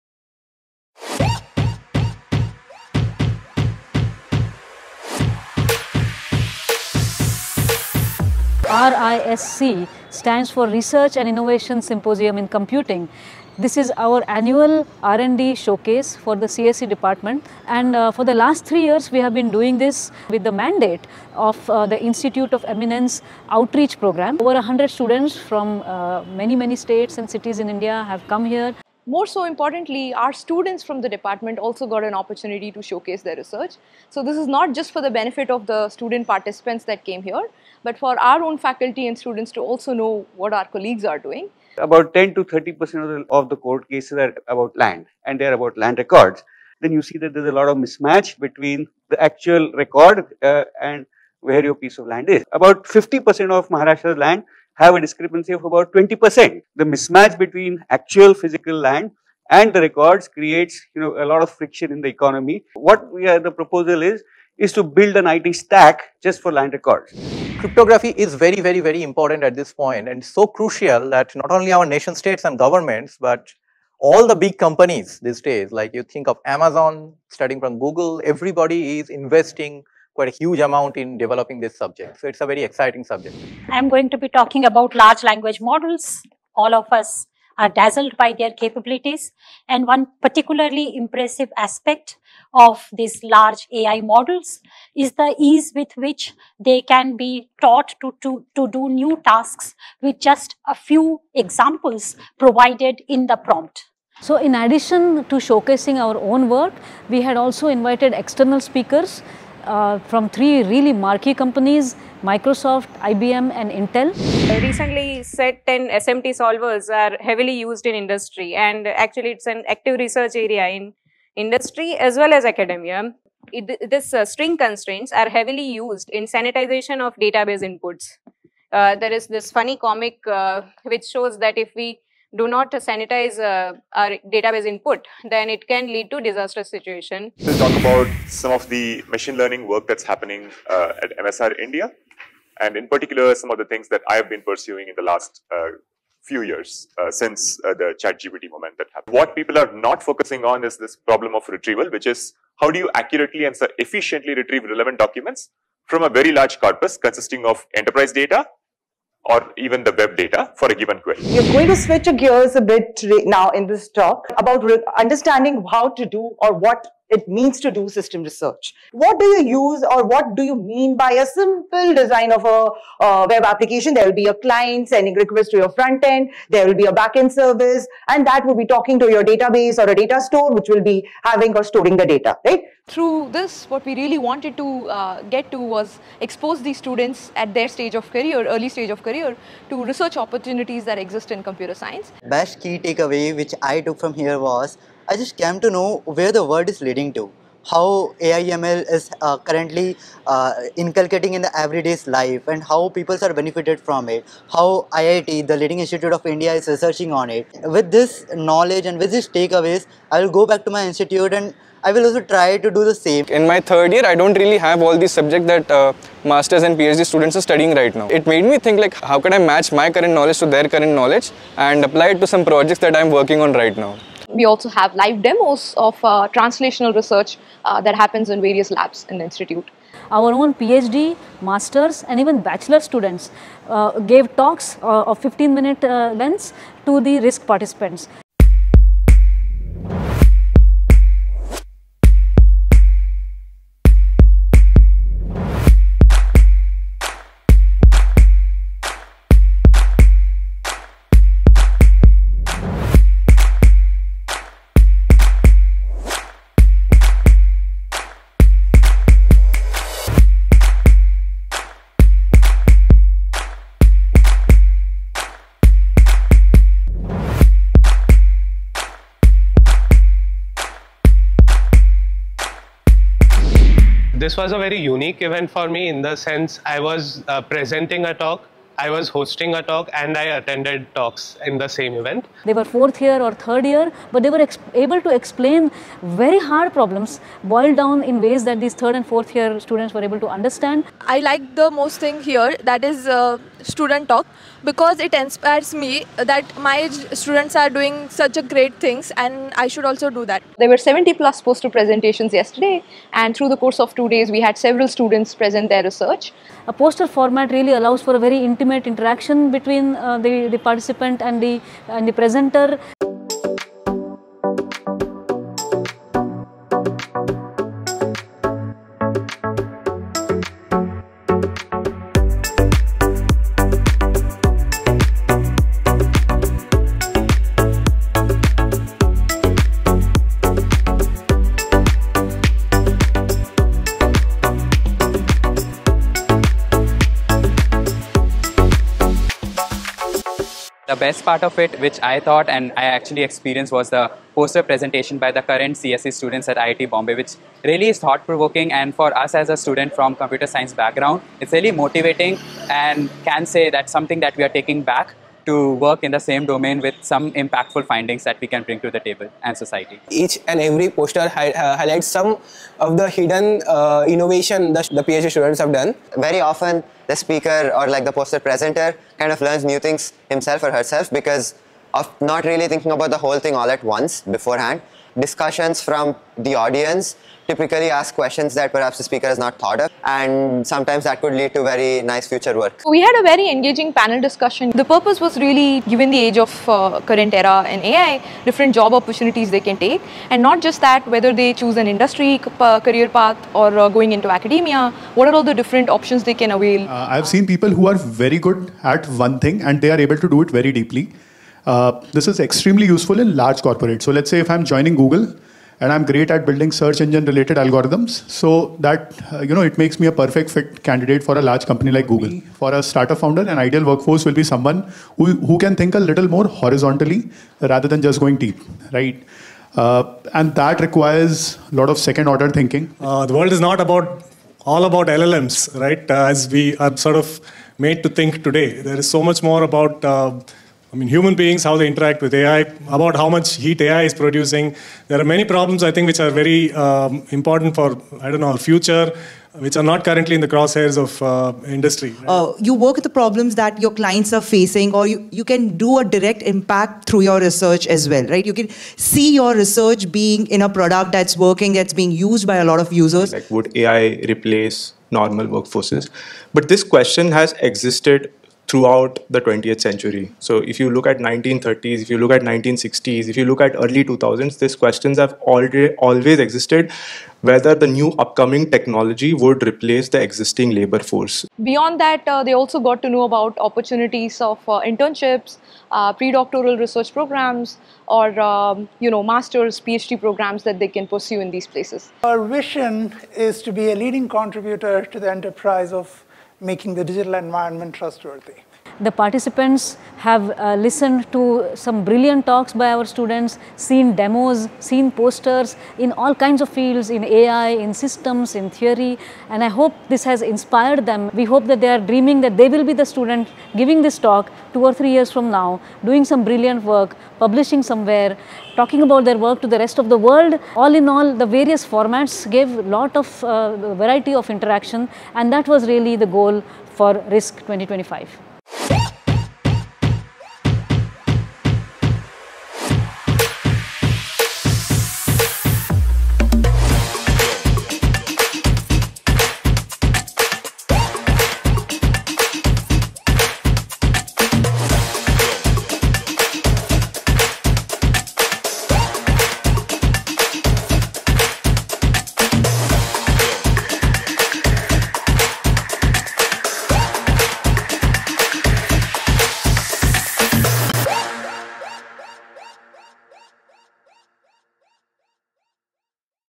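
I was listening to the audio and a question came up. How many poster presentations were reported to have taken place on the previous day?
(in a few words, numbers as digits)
70 plus.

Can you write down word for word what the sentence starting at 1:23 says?
I'm going to be talking about large language models.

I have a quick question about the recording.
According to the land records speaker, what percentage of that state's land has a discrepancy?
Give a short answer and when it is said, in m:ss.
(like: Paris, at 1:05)
50%, at 0:52.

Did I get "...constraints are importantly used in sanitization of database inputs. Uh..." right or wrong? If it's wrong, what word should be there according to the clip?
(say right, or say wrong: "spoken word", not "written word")
wrong: "heavily", not "importantly".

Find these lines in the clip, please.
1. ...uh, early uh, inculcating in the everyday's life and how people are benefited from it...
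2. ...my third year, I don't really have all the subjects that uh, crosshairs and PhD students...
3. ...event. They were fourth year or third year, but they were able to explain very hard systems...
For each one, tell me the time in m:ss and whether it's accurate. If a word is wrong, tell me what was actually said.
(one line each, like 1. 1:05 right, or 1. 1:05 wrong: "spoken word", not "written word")
1. 3:19 wrong: "currently", not "early"
2. 3:33 wrong: "masters", not "crosshairs"
3. 4:41 wrong: "problems", not "systems".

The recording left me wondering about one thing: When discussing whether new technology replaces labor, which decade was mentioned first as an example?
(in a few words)
1930s.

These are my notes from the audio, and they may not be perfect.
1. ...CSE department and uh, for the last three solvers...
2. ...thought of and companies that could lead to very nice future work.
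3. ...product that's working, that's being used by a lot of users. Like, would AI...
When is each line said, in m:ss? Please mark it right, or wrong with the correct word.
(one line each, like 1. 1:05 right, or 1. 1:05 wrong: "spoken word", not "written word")
1. 0:16 wrong: "years", not "solvers"
2. 6:19 wrong: "sometimes", not "companies"
3. 7:30 right.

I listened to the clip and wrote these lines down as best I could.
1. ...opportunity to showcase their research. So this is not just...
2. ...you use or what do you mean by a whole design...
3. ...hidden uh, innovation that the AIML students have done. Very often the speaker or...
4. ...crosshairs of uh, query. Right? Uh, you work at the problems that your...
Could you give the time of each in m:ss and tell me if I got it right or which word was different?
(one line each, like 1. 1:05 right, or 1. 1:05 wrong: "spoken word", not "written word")
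1. 0:32 right
2. 2:49 wrong: "simple", not "whole"
3. 6:03 wrong: "PhD", not "AIML"
4. 7:20 wrong: "industry", not "query".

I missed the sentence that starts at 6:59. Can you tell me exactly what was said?
Uh, and that requires a lot of second order thinking.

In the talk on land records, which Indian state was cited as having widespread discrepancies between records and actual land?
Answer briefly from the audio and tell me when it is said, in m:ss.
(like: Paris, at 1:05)
Maharashtra, at 0:53.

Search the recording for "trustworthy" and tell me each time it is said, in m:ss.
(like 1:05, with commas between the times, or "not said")
8:07.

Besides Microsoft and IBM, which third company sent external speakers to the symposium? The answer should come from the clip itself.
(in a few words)
Intel.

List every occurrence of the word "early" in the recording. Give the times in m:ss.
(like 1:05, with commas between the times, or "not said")
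3:08, 7:43.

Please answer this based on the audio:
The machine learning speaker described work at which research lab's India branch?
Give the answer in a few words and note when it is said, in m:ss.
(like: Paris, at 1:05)
MSR India, at 2:21.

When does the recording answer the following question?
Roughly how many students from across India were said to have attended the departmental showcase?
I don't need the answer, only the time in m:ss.
0:24.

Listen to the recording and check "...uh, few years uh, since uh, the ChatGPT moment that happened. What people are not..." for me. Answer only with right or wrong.
right.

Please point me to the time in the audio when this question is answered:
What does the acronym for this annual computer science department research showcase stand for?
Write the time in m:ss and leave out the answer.
0:10.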